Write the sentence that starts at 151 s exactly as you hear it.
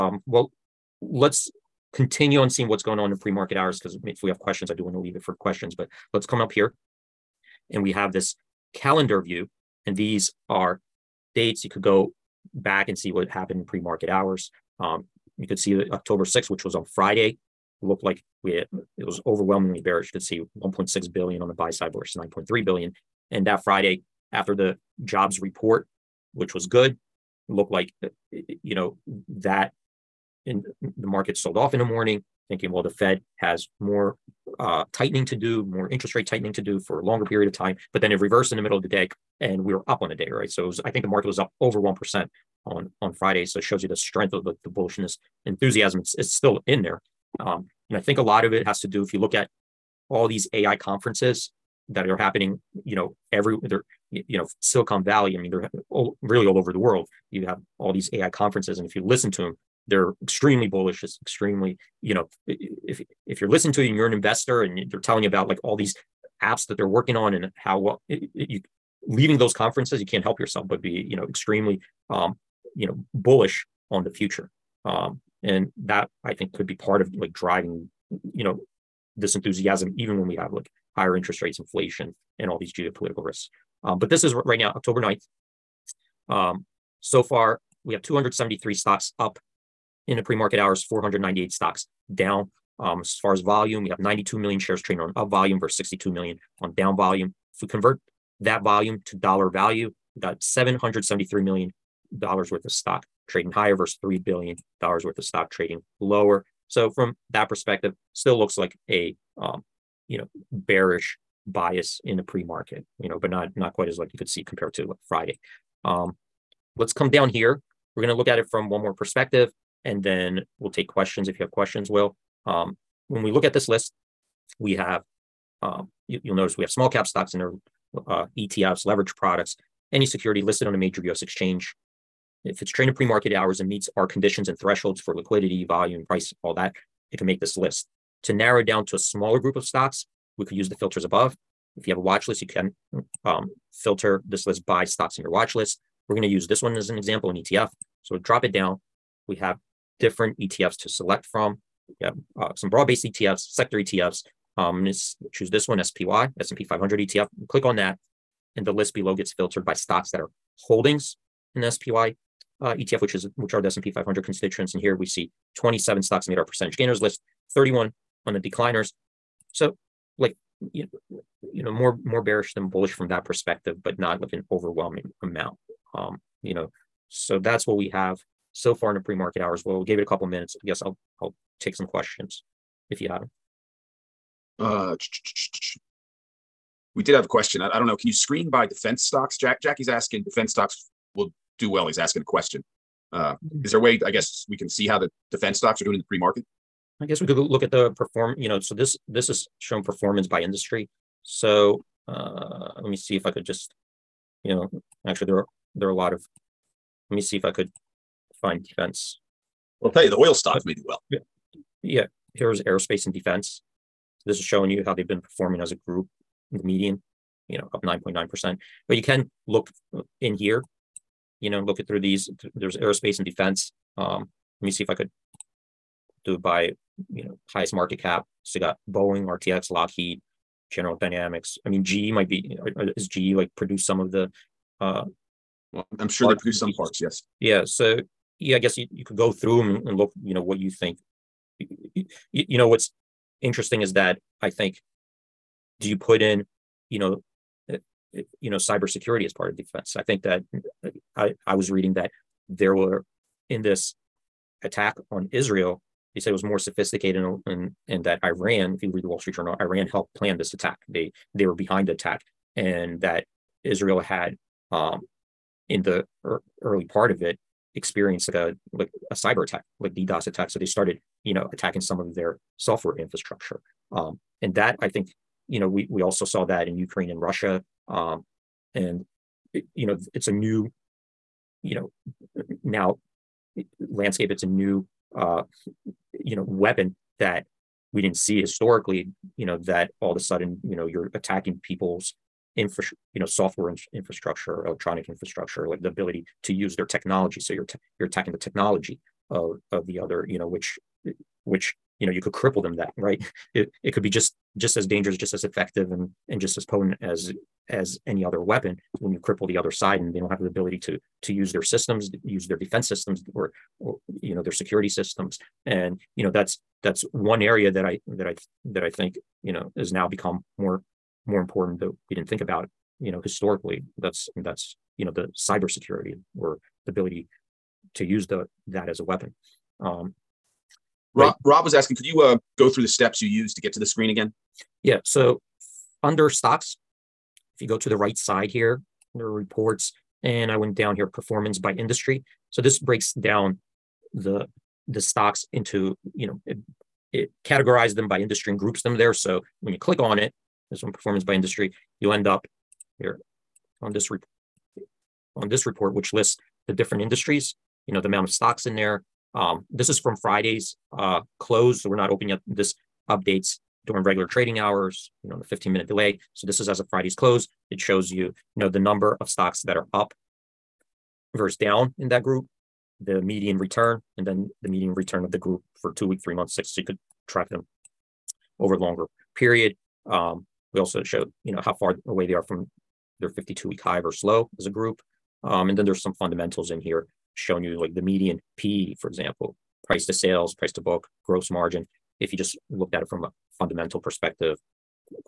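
We have uh, some broad-based ETFs, sector ETFs.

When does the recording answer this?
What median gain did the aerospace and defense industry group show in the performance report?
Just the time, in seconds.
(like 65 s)
217 s.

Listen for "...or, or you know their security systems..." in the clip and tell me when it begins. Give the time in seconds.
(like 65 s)
313 s.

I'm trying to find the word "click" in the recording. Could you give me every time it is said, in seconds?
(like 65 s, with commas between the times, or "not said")
157 s, 349 s.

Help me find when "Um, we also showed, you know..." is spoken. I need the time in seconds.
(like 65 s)
380 s.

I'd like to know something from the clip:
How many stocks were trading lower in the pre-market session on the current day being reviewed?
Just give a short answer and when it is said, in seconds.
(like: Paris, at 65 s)
498, at 90 s.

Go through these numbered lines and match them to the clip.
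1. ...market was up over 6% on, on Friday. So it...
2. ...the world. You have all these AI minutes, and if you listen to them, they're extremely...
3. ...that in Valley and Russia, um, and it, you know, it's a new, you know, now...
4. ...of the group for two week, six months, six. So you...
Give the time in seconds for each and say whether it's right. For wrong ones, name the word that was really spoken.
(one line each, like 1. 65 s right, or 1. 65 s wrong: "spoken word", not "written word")
1. 41 s wrong: "1", not "6"
2. 56 s wrong: "conferences", not "minutes"
3. 276 s wrong: "Ukraine", not "Valley"
4. 375 s wrong: "three", not "six".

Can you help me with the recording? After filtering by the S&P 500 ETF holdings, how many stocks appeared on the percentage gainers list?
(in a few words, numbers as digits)
27.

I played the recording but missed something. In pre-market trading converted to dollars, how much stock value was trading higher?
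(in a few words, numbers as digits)
$773 million.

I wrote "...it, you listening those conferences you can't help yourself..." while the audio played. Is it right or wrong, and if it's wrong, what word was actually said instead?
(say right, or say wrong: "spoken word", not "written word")
wrong: "leaving", not "listening".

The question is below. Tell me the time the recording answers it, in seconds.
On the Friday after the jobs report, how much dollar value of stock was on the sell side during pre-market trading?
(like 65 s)
22 s.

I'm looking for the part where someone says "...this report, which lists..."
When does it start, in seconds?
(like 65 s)
355 s.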